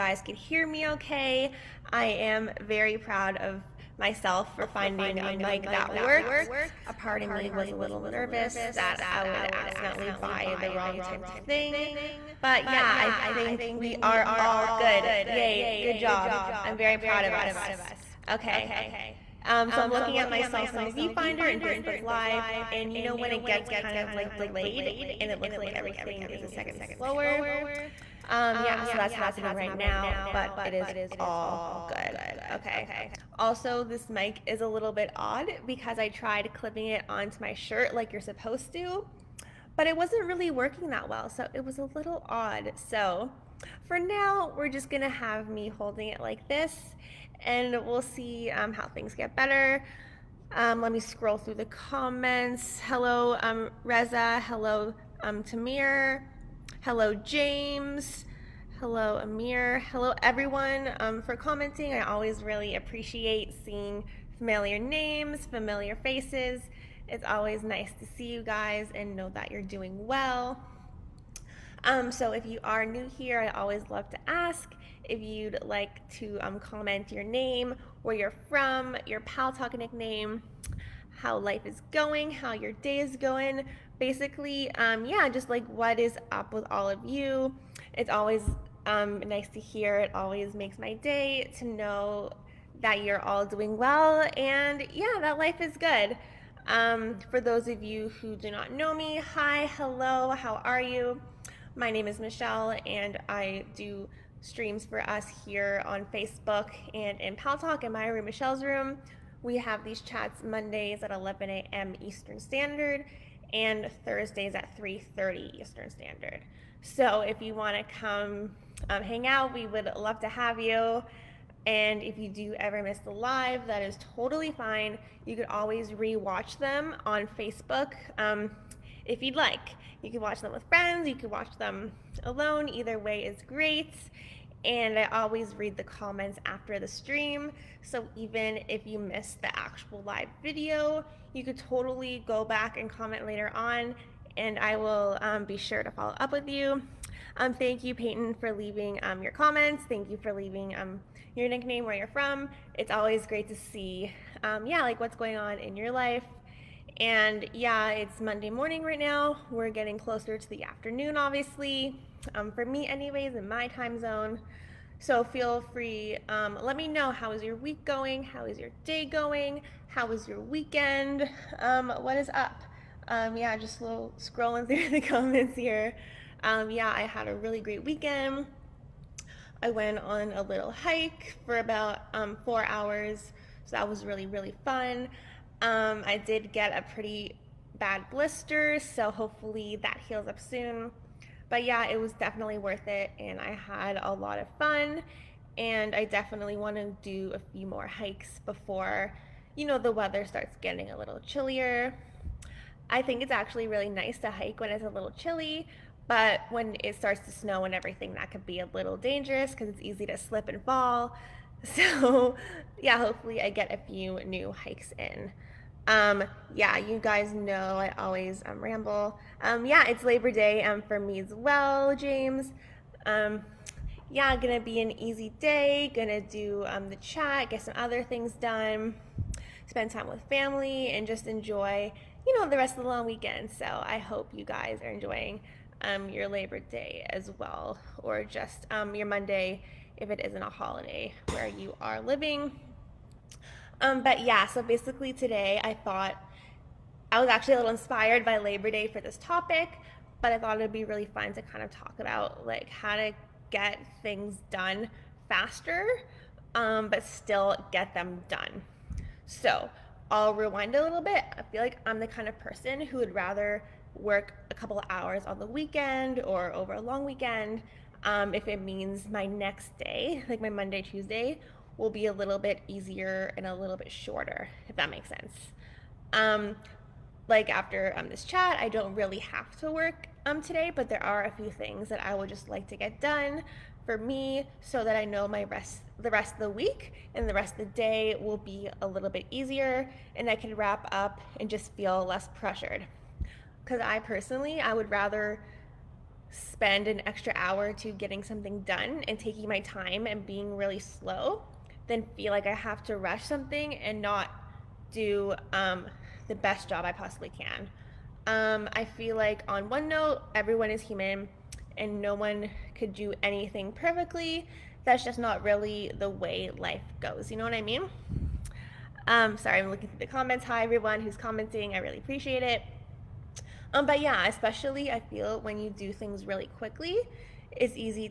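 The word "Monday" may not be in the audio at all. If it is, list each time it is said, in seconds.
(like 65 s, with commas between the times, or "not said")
110 s, 158 s, 239 s, 270 s.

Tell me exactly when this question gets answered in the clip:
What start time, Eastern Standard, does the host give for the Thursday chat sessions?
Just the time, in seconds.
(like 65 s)
114 s.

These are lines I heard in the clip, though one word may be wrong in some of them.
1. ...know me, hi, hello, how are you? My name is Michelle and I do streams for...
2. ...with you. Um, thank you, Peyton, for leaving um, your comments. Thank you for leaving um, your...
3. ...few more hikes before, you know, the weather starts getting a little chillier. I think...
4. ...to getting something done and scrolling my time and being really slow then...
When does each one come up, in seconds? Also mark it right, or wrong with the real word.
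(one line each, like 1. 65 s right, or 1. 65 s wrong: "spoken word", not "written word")
1. 98 s right
2. 146 s right
3. 197 s right
4. 297 s wrong: "taking", not "scrolling".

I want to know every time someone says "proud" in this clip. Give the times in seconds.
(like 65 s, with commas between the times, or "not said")
2 s, 16 s.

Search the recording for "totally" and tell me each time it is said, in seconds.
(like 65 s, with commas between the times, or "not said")
124 s, 141 s.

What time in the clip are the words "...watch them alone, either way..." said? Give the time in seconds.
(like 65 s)
131 s.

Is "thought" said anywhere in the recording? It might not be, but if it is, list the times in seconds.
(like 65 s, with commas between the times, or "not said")
245 s, 250 s.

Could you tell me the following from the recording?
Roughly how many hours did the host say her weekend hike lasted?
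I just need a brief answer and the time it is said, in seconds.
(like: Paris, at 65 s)
4, at 182 s.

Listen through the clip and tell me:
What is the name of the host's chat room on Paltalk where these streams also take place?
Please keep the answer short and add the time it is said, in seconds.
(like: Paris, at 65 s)
Michelle's room, at 108 s.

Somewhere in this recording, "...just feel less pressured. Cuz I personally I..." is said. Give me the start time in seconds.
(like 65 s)
291 s.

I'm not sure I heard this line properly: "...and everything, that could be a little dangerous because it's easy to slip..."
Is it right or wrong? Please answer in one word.
right.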